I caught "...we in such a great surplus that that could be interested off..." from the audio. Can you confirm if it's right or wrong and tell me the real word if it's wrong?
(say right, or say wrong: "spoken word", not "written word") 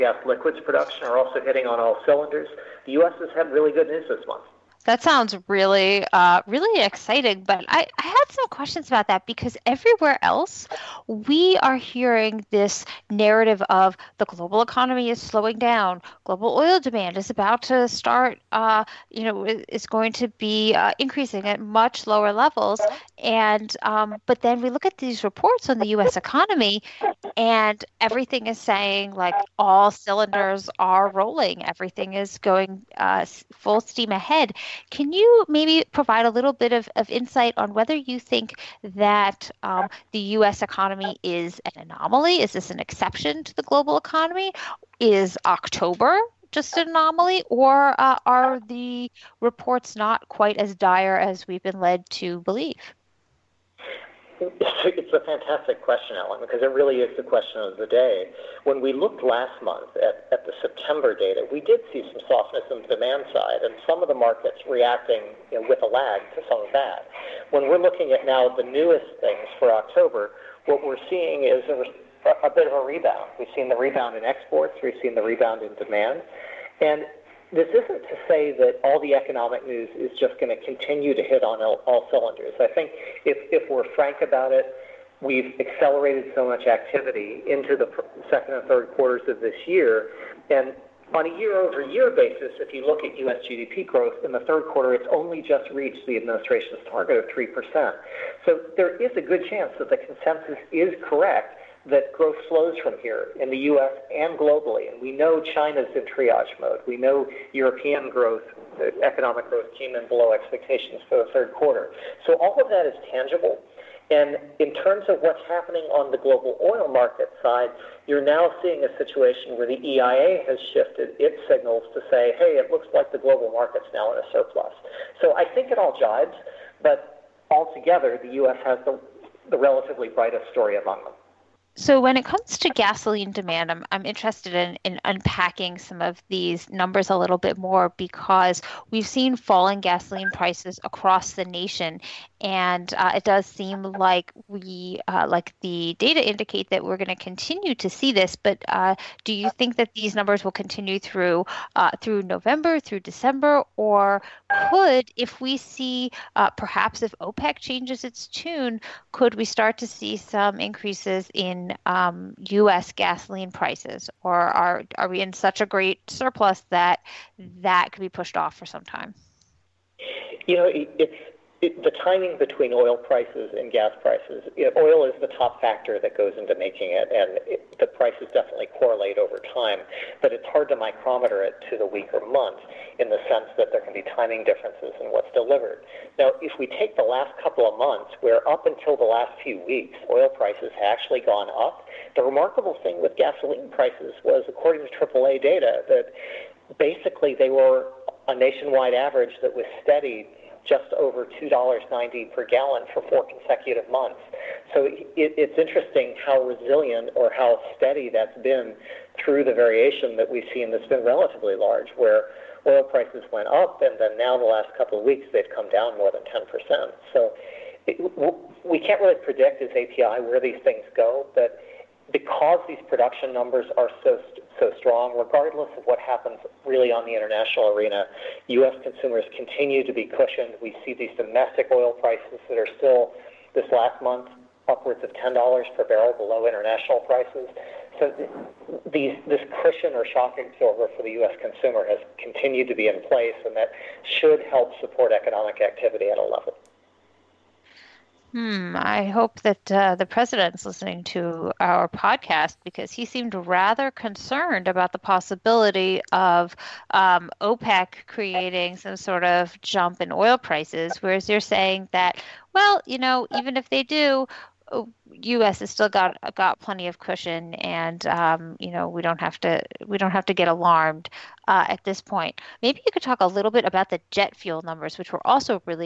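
wrong: "pushed", not "interested".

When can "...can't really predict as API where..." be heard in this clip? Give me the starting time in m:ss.
3:38.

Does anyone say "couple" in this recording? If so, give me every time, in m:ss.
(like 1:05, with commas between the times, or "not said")
3:07, 3:34.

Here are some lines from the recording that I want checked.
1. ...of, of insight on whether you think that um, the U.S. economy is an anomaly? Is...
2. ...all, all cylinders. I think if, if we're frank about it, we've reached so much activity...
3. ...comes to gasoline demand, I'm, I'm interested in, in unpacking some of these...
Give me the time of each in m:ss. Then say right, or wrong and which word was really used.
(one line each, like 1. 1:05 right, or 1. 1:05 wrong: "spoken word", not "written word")
1. 0:36 right
2. 1:21 wrong: "accelerated", not "reached"
3. 2:12 right.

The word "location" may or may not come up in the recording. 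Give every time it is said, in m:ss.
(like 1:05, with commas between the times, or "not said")
not said.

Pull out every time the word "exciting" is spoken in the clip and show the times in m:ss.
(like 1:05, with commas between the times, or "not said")
0:06.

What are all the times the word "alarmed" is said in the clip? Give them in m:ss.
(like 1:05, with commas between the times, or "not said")
4:30.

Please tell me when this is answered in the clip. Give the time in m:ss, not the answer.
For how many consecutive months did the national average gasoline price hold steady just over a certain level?
3:23.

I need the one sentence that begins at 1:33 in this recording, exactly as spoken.
GDP growth in the third quarter, it's only just reached the administration's target of 3%.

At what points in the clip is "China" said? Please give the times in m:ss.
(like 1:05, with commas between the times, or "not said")
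1:45.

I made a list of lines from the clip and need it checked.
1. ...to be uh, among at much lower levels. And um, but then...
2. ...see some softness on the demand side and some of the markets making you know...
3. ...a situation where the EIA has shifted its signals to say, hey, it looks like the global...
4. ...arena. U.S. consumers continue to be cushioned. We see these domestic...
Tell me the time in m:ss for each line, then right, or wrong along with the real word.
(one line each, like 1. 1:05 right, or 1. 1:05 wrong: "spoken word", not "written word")
1. 0:20 wrong: "increasing", not "among"
2. 1:01 wrong: "reacting", not "making"
3. 1:58 right
4. 3:47 right.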